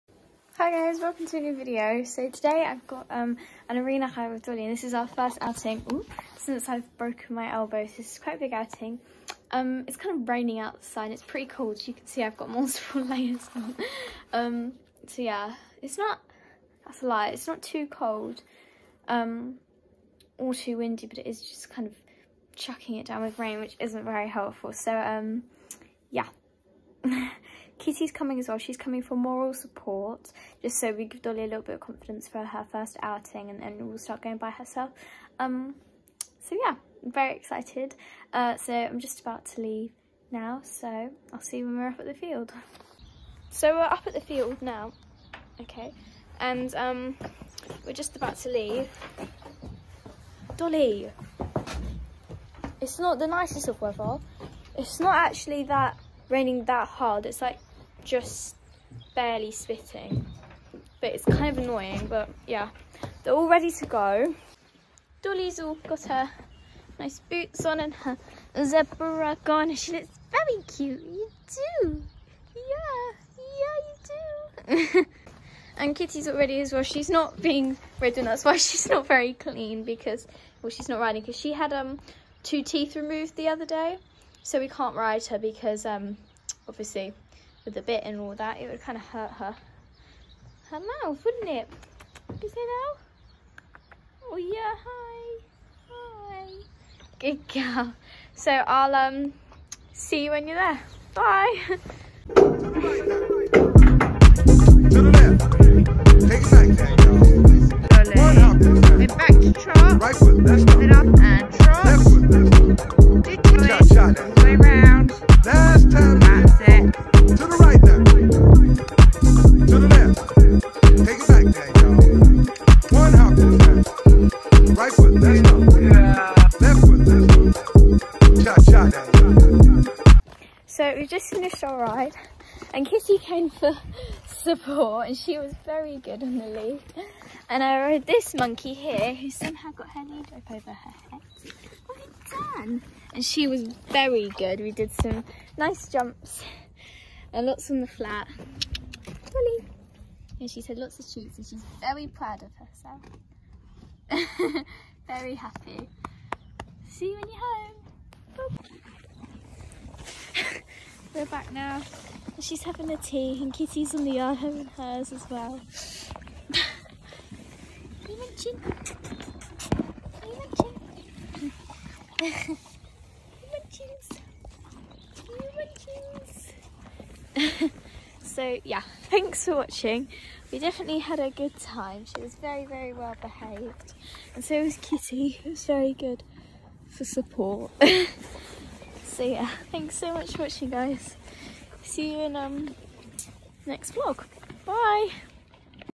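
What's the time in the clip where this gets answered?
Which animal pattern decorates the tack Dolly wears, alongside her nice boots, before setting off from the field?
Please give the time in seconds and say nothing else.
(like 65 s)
68 s.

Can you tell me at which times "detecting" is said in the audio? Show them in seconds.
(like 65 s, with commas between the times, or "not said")
not said.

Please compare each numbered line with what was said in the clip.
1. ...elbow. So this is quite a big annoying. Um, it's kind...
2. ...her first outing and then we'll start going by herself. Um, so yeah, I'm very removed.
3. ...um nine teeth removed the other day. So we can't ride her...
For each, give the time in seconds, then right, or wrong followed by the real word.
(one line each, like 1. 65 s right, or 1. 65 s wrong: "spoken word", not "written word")
1. 7 s wrong: "outing", not "annoying"
2. 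32 s wrong: "excited", not "removed"
3. 81 s wrong: "two", not "nine".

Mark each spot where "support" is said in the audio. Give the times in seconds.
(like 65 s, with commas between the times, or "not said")
29 s, 134 s, 187 s.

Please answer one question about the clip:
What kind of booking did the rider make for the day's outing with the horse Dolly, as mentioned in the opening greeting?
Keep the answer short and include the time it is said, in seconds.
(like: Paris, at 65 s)
Arena hire, at 3 s.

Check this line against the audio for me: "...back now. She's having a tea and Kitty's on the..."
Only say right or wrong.
right.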